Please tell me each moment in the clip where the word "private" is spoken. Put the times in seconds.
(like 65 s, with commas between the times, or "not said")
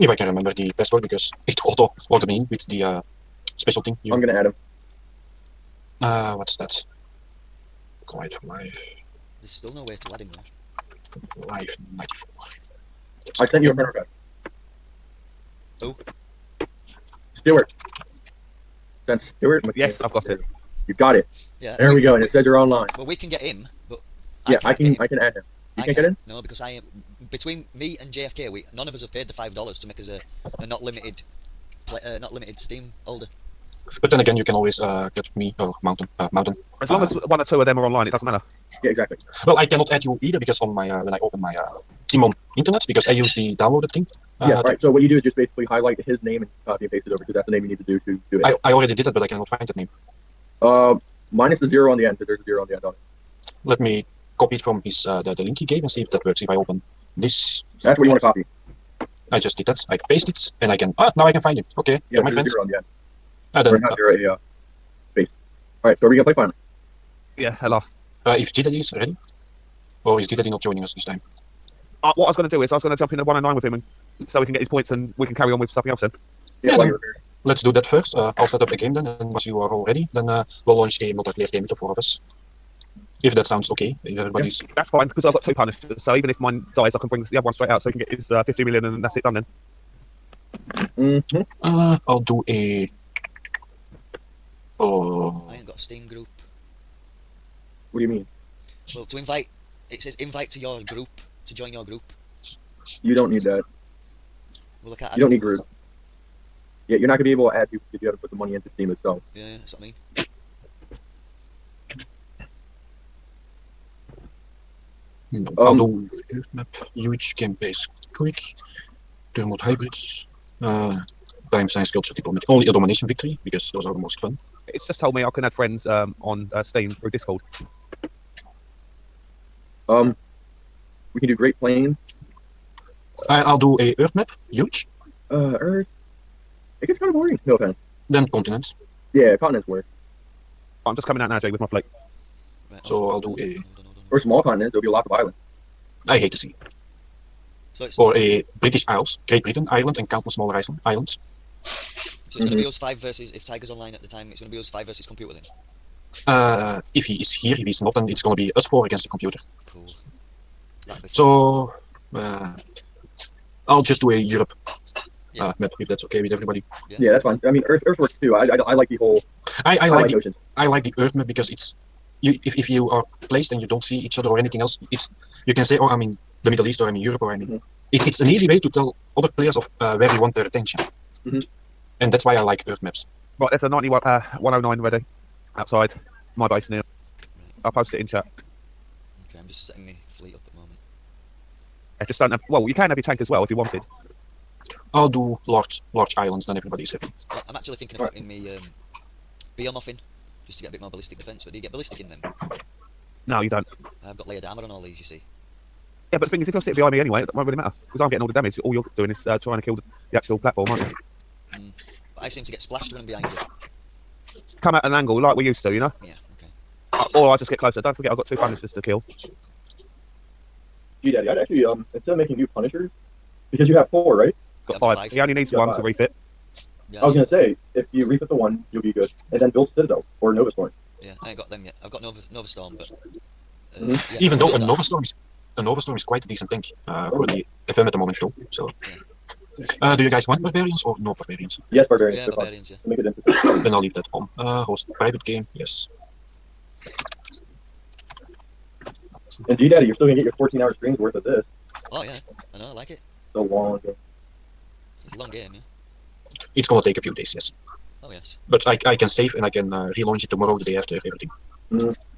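244 s.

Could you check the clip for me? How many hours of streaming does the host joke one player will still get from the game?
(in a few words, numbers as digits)
14.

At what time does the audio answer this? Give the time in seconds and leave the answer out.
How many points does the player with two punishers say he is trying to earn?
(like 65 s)
88 s.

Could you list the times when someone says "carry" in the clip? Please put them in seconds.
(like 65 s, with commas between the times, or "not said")
75 s.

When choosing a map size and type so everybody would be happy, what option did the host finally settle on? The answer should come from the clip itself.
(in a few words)
Large islands.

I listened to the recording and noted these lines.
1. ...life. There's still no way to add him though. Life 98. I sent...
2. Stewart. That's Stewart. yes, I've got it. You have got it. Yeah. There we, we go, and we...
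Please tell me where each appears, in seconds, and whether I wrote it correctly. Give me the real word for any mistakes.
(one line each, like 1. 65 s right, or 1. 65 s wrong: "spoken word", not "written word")
1. 8 s wrong: "94", not "98"
2. 17 s right.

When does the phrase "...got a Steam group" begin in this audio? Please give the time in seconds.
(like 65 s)
95 s.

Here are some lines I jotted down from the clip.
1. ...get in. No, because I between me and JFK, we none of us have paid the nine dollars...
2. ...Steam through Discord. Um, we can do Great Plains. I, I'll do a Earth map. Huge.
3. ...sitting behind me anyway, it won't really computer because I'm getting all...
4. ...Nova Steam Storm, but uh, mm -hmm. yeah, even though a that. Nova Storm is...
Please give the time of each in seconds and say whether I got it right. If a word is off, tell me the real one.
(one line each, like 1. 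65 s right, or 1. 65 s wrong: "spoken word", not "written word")
1. 25 s wrong: "five", not "nine"
2. 126 s right
3. 206 s wrong: "matter", not "computer"
4. 232 s wrong: "Nova", not "Steam".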